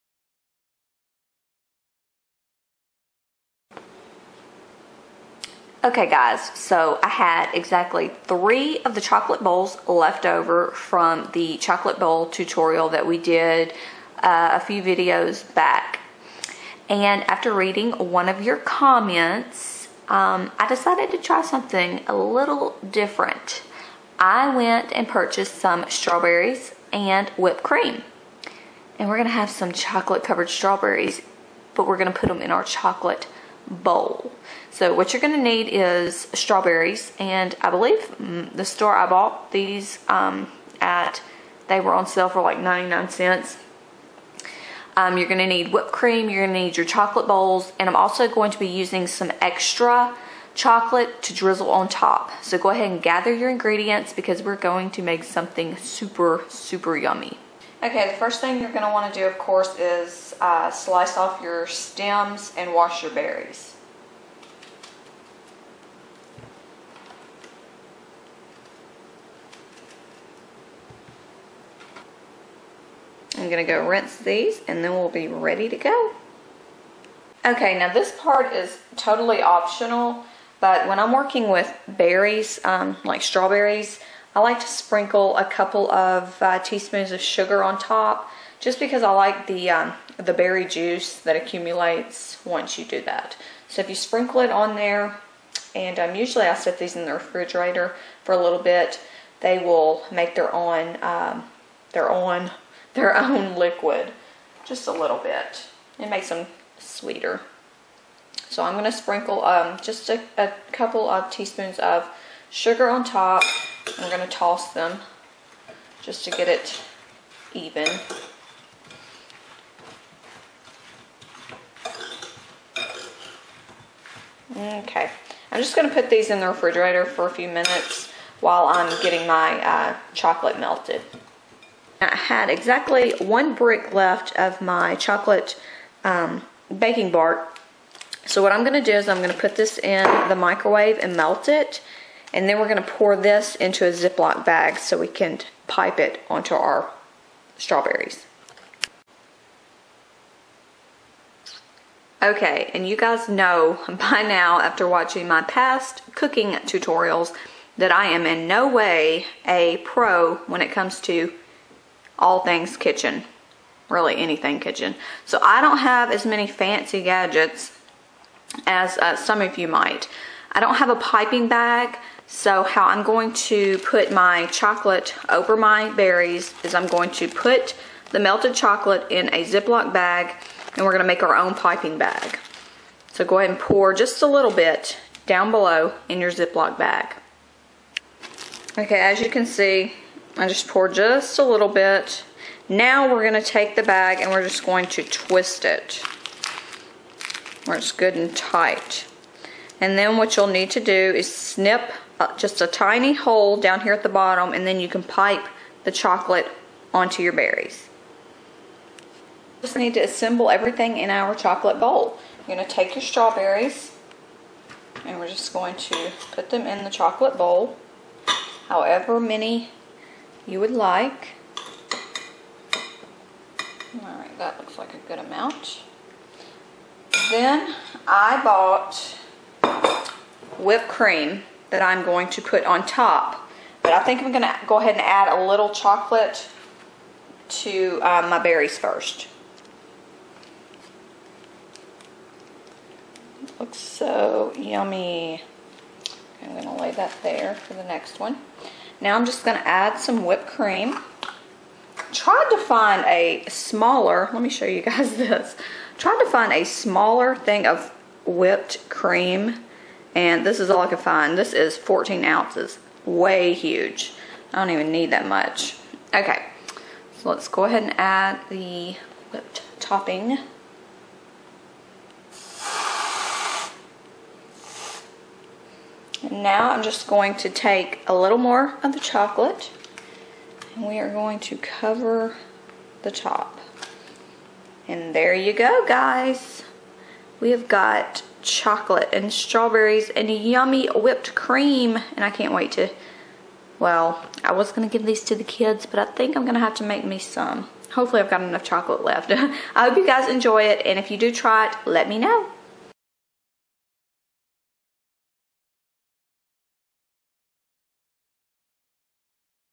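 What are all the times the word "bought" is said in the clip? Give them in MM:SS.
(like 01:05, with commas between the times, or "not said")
00:39, 03:48.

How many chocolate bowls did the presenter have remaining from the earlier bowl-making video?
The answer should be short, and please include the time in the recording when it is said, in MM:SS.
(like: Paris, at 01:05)
3, at 00:08.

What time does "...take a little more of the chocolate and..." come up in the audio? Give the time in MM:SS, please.
04:37.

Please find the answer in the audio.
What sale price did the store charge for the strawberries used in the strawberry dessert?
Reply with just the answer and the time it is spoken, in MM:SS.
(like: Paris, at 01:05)
99 cents, at 00:42.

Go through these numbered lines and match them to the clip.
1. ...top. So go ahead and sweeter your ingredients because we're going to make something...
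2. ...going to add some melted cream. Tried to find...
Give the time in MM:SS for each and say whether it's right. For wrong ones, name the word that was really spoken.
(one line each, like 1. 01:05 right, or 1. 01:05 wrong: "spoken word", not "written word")
1. 00:51 wrong: "gather", not "sweeter"
2. 04:09 wrong: "whipped", not "melted".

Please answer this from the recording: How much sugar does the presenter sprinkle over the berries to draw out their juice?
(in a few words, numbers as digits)
A couple of teaspoons.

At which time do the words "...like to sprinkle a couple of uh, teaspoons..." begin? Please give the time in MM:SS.
01:24.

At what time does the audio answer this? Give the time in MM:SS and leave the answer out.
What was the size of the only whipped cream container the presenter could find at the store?
04:21.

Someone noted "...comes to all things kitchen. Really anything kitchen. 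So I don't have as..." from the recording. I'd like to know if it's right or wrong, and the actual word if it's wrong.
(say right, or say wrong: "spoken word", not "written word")
right.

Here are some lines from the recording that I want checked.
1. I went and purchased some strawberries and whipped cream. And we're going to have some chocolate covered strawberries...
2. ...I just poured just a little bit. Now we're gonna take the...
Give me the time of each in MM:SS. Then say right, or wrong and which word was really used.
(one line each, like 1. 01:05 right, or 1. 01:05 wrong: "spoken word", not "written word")
1. 00:24 right
2. 03:10 right.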